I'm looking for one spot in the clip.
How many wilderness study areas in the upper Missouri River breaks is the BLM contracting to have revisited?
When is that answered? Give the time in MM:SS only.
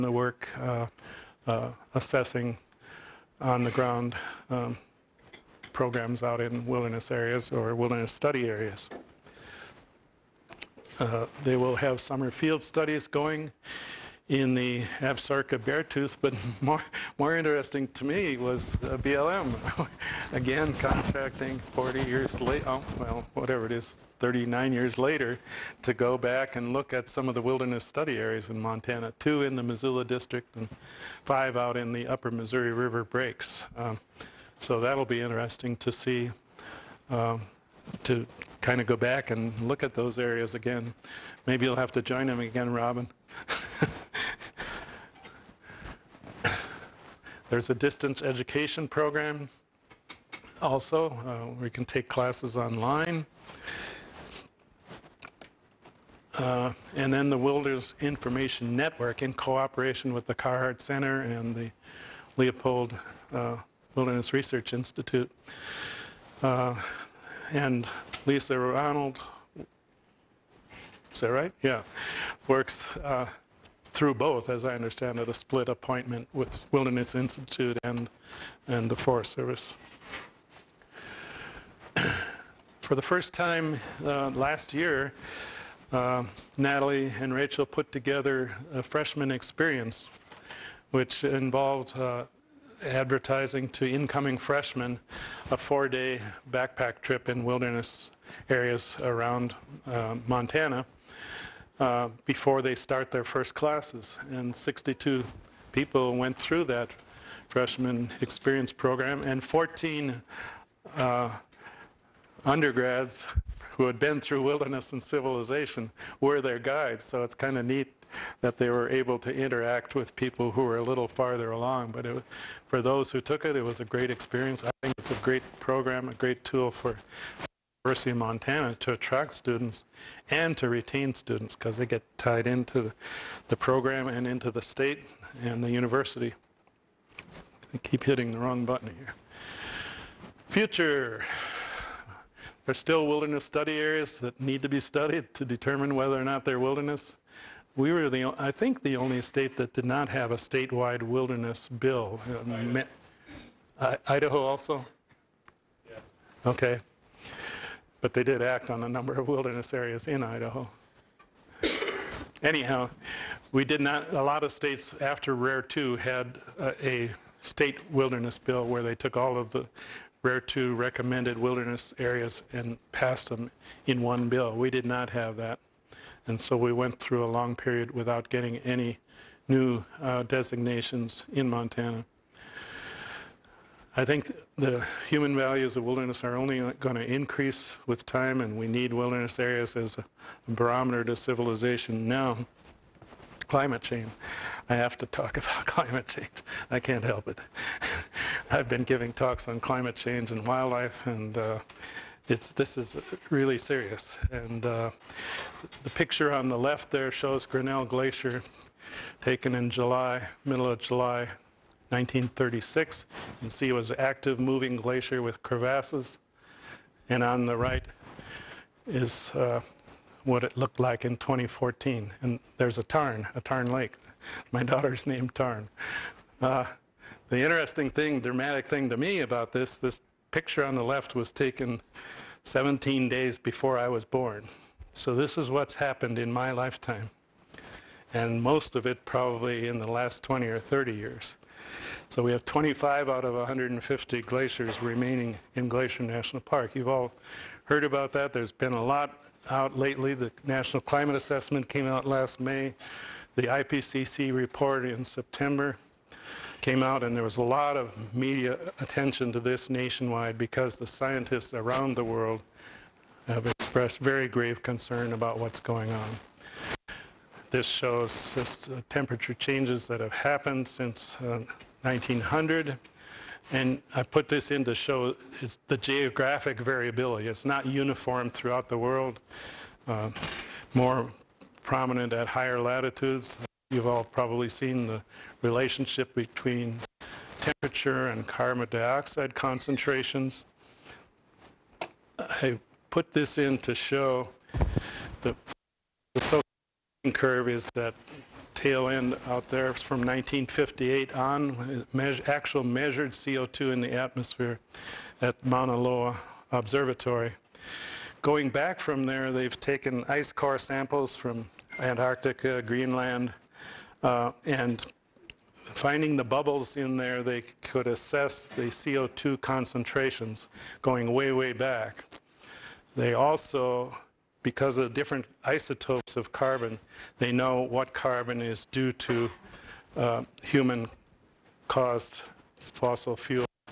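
00:31.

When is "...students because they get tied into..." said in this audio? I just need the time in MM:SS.
02:11.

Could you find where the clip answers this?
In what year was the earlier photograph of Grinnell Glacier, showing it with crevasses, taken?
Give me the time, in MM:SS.
03:31.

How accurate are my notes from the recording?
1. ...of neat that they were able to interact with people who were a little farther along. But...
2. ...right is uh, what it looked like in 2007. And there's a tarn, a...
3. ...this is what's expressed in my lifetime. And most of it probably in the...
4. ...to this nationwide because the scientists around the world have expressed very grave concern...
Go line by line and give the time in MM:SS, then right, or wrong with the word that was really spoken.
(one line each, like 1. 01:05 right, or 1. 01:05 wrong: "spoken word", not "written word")
1. 01:57 right
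2. 03:37 wrong: "2014", not "2007"
3. 03:55 wrong: "happened", not "expressed"
4. 04:19 right.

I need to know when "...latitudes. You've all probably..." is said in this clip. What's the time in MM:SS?
04:42.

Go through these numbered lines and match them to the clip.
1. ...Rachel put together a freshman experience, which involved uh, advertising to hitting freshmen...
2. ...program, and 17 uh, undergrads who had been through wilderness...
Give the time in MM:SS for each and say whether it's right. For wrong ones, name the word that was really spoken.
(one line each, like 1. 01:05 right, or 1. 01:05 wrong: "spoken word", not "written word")
1. 01:27 wrong: "incoming", not "hitting"
2. 01:48 wrong: "14", not "17".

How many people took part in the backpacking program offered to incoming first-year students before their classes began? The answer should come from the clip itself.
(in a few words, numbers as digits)
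62.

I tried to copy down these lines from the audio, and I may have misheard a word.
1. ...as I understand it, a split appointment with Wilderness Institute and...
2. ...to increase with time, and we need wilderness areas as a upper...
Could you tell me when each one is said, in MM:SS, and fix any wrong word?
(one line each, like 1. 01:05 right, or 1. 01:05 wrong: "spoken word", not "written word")
1. 01:14 right
2. 03:06 wrong: "barometer", not "upper".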